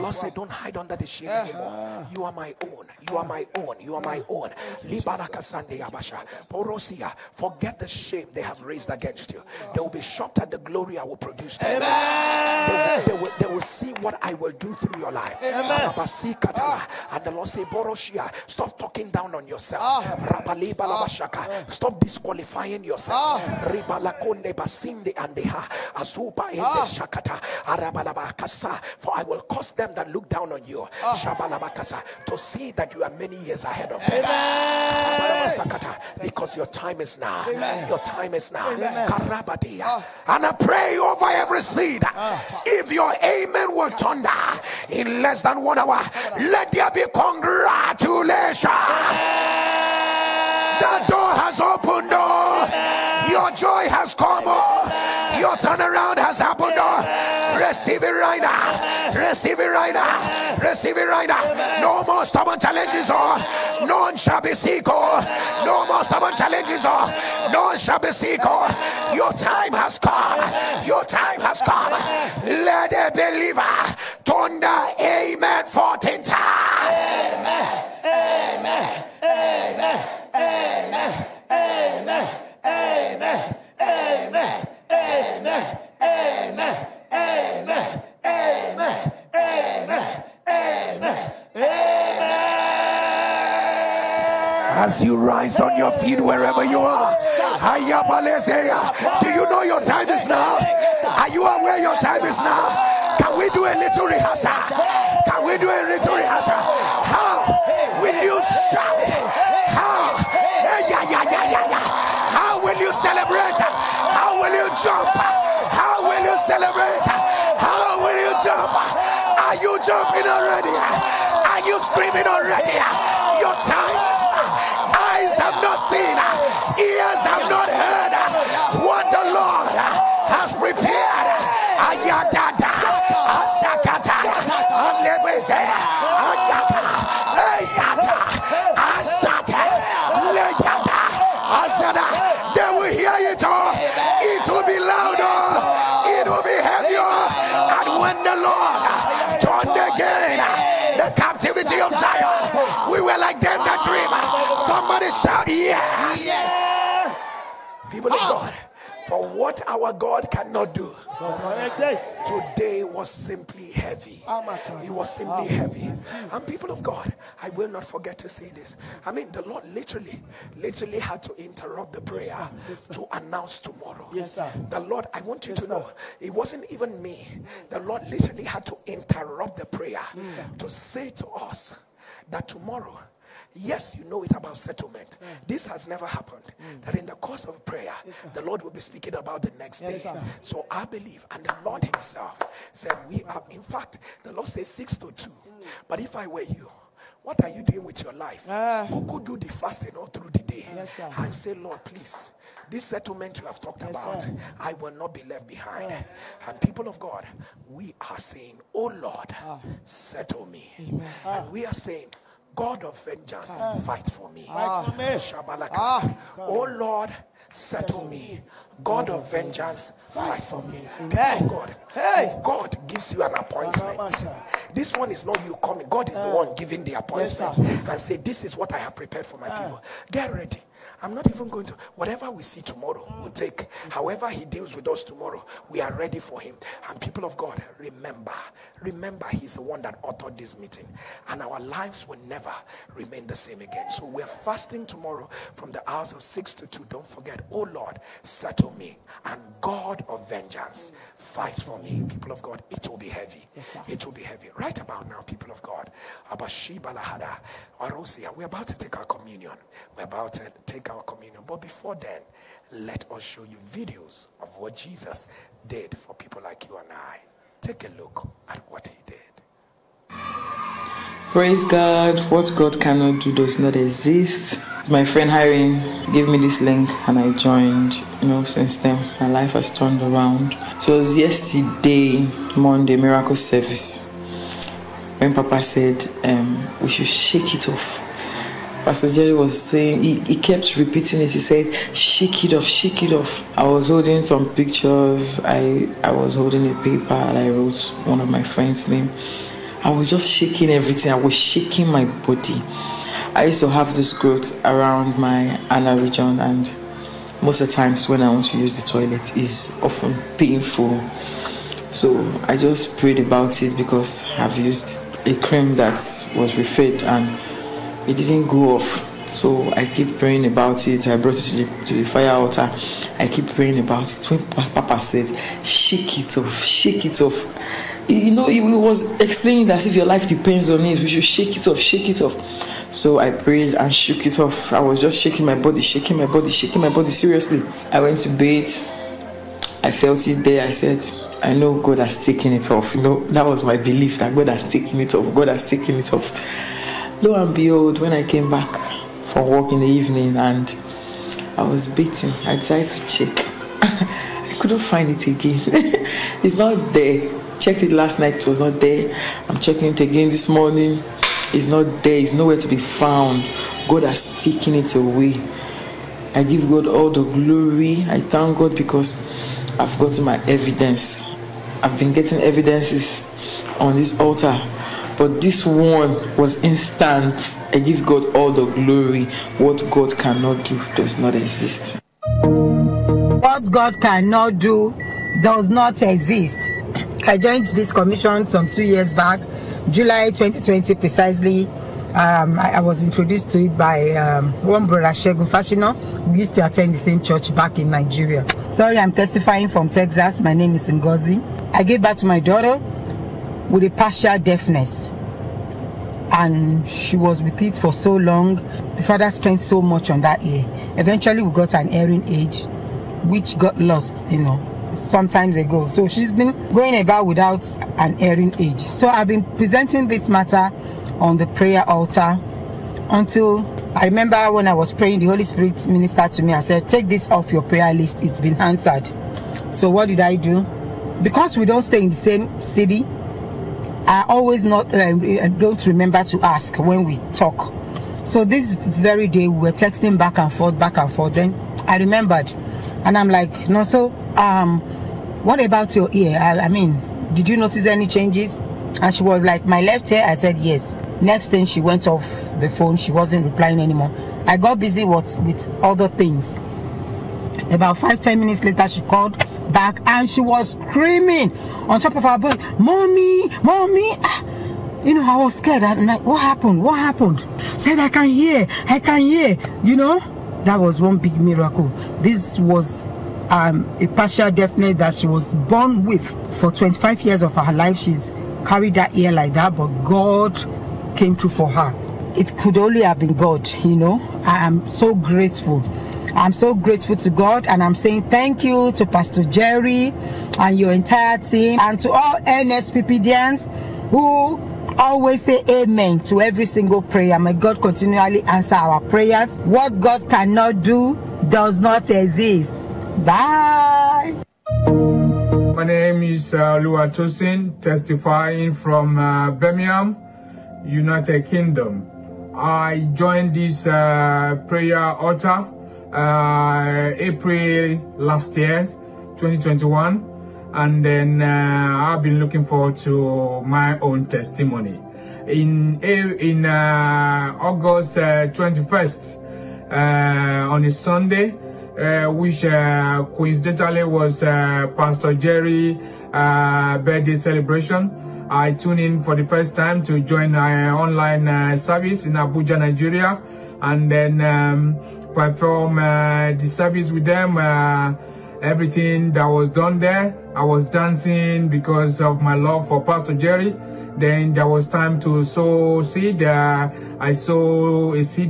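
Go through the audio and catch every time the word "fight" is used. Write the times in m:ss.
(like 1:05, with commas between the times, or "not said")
3:33, 3:40, 4:11.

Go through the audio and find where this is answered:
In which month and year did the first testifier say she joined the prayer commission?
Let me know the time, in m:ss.
6:29.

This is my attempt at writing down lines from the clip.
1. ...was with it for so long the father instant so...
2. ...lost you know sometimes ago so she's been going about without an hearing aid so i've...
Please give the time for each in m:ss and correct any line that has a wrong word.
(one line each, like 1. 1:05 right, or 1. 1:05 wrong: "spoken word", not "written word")
1. 6:47 wrong: "spent", not "instant"
2. 6:53 right.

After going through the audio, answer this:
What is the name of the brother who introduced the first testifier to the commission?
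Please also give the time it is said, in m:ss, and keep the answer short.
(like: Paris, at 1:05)
Shegun Fashino, at 6:35.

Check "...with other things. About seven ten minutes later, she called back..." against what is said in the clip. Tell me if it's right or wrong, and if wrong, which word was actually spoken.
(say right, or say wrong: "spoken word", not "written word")
wrong: "five", not "seven".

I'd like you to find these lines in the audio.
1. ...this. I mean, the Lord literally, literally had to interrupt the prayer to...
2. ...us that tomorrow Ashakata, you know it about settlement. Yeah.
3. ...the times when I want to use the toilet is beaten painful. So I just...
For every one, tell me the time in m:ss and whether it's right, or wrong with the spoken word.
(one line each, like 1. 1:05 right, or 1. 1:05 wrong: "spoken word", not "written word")
1. 2:48 right
2. 3:01 wrong: "Yes", not "Ashakata"
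3. 5:07 wrong: "often", not "beaten".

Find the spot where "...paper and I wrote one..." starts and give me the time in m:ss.
4:56.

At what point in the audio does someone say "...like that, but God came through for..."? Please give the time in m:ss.
7:59.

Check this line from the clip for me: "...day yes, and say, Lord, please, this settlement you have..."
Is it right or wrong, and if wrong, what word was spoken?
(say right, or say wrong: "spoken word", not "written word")
right.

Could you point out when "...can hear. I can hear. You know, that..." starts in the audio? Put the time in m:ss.
7:48.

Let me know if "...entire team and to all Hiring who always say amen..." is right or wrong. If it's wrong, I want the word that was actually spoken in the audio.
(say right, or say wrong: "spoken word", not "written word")
wrong: "NSPPDians", not "Hiring".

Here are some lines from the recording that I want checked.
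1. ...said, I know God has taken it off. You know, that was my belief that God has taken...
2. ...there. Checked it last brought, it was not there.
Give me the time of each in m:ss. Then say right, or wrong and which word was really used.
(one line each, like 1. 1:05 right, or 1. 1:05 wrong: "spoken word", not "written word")
1. 5:40 right
2. 5:56 wrong: "night", not "brought".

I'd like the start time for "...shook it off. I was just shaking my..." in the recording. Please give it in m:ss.
5:33.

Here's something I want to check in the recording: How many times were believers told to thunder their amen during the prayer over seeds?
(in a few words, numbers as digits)
14.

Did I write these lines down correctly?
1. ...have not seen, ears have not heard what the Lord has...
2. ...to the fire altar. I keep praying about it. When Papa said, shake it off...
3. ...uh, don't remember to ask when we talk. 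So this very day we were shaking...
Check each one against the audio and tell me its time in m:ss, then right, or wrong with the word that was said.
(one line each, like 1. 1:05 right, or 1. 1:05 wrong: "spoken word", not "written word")
1. 2:05 right
2. 5:21 right
3. 7:14 wrong: "texting", not "shaking".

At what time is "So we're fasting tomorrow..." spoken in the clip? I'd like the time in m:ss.
4:03.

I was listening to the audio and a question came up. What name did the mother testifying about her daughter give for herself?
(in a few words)
Ngozi.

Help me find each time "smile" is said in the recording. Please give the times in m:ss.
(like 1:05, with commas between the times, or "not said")
not said.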